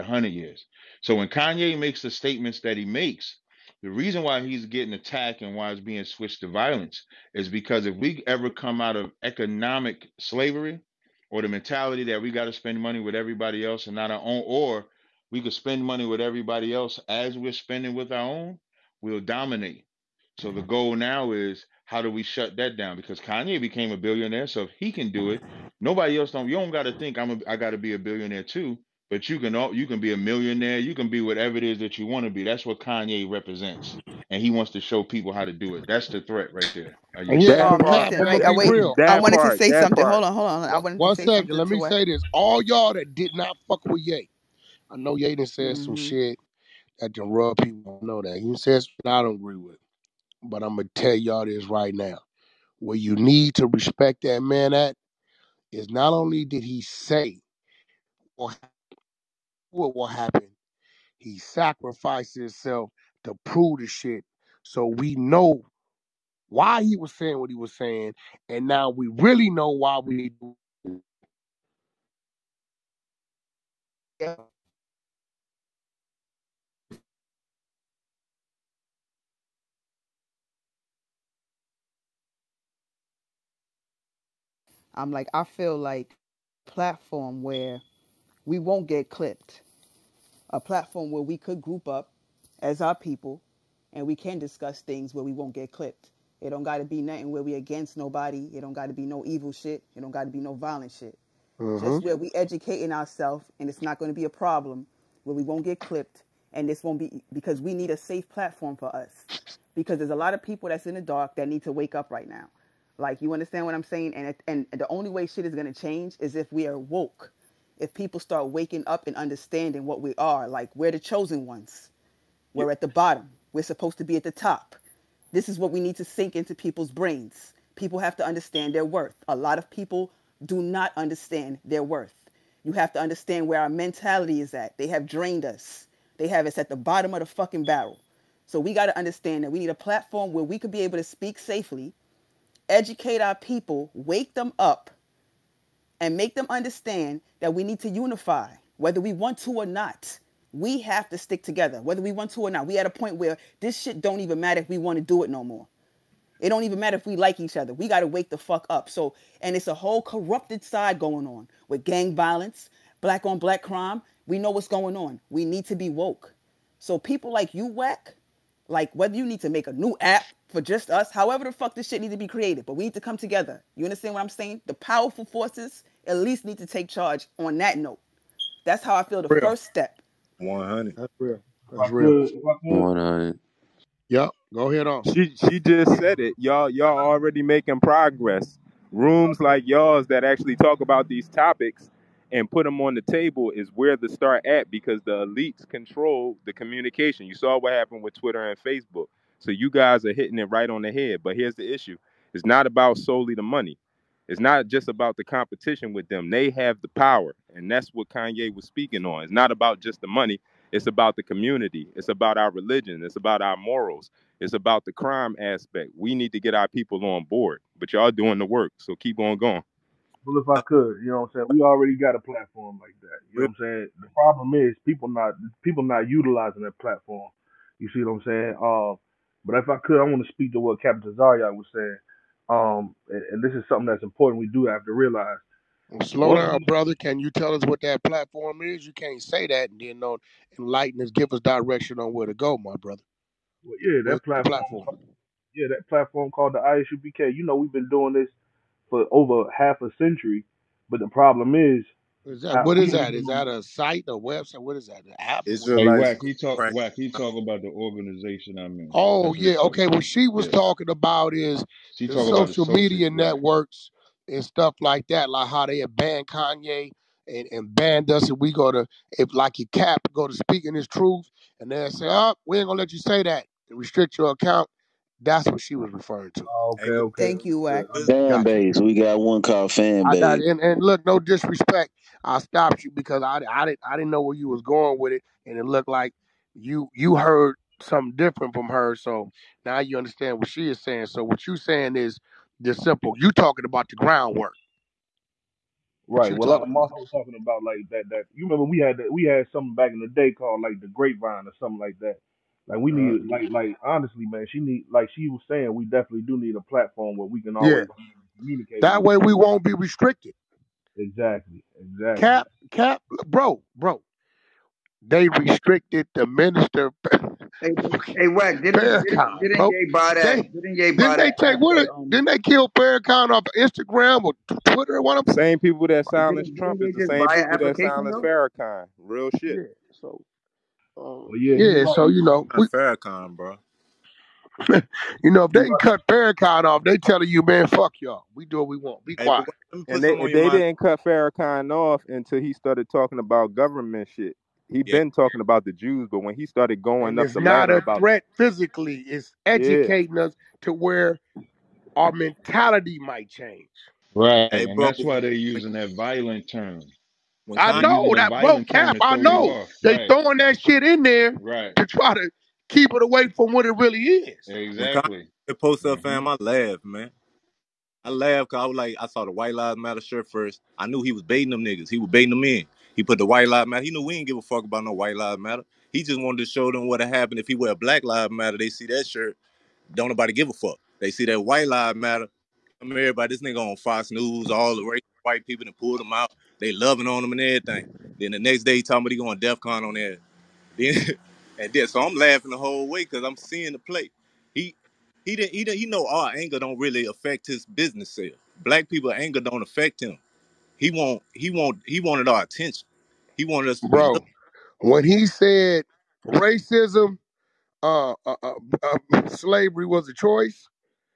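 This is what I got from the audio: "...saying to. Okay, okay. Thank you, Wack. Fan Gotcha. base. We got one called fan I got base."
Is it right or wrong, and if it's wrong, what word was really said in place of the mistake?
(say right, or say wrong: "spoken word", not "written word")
wrong: "referring", not "saying".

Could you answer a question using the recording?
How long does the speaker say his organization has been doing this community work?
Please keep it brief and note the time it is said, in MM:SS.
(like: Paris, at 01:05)
Over half a century, at 04:09.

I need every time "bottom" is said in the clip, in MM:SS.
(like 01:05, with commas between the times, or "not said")
02:02, 02:16.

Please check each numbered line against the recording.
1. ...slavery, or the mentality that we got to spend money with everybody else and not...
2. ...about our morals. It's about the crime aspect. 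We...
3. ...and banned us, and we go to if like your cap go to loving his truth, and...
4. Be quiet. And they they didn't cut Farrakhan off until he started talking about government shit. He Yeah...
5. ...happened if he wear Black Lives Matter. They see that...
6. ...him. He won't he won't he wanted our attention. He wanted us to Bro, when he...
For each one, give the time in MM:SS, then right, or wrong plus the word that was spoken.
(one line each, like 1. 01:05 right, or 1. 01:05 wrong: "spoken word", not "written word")
1. 00:10 right
2. 03:33 right
3. 04:27 wrong: "speaking", not "loving"
4. 05:39 right
5. 06:16 right
6. 06:40 right.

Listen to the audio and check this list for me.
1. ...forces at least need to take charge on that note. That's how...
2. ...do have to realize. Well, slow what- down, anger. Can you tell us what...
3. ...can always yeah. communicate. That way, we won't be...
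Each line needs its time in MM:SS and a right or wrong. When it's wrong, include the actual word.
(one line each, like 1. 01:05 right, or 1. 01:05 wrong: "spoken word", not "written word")
1. 02:55 right
2. 03:54 wrong: "brother", not "anger"
3. 05:07 right.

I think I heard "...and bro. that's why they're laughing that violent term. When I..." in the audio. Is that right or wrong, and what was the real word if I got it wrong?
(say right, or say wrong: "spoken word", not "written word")
wrong: "using", not "laughing".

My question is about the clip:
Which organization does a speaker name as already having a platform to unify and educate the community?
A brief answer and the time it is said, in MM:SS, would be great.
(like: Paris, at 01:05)
ISUPK, at 04:06.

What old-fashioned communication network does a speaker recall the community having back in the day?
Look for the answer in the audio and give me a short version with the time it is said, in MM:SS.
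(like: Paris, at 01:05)
The grapevine, at 05:00.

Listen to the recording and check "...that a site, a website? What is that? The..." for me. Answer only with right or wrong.
right.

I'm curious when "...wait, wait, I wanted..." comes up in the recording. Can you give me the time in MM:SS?
00:38.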